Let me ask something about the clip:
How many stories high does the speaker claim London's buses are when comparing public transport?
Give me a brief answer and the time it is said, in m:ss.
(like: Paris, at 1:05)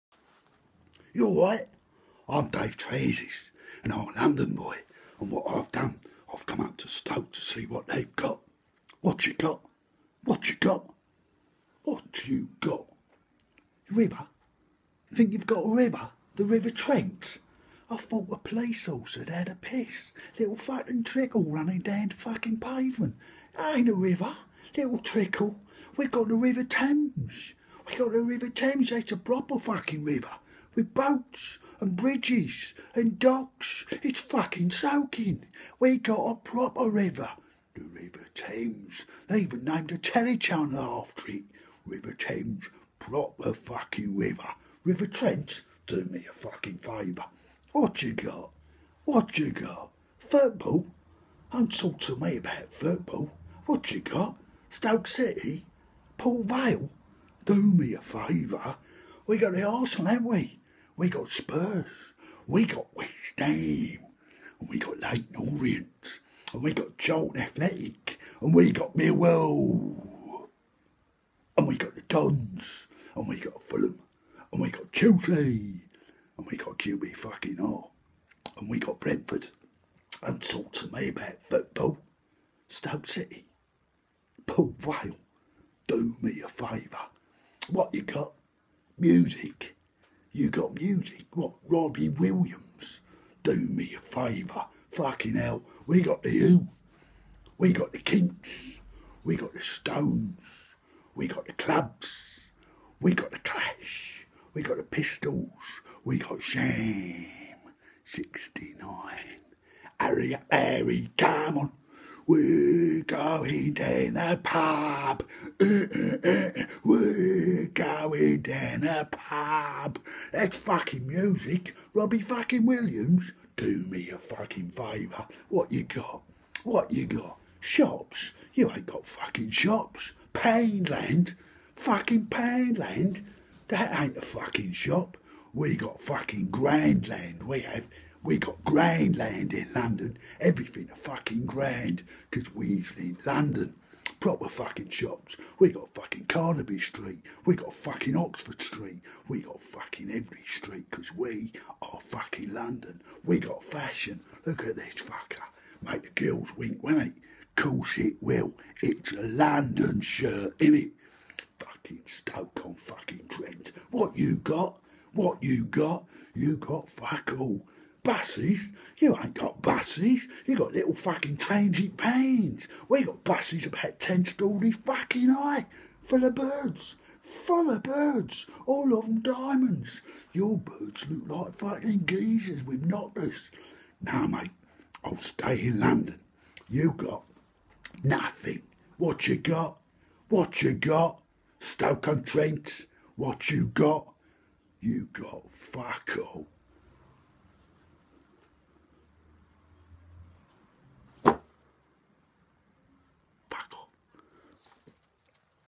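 10, at 2:53.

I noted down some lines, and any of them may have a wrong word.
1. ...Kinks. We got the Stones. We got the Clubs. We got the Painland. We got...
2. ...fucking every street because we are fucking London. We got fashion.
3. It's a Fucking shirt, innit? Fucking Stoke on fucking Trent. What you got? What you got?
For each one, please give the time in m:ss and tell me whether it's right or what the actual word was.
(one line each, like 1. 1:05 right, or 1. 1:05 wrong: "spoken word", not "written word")
1. 1:37 wrong: "Clash", not "Painland"
2. 2:29 right
3. 2:38 wrong: "London", not "Fucking".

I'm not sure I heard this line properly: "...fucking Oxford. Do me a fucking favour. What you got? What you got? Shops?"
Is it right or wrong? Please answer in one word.
wrong.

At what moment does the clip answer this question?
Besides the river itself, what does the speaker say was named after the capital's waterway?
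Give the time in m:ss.
0:39.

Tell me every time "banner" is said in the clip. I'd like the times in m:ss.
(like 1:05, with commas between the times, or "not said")
not said.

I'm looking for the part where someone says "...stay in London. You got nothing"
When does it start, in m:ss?
3:05.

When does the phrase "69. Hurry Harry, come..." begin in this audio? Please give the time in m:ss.
1:48.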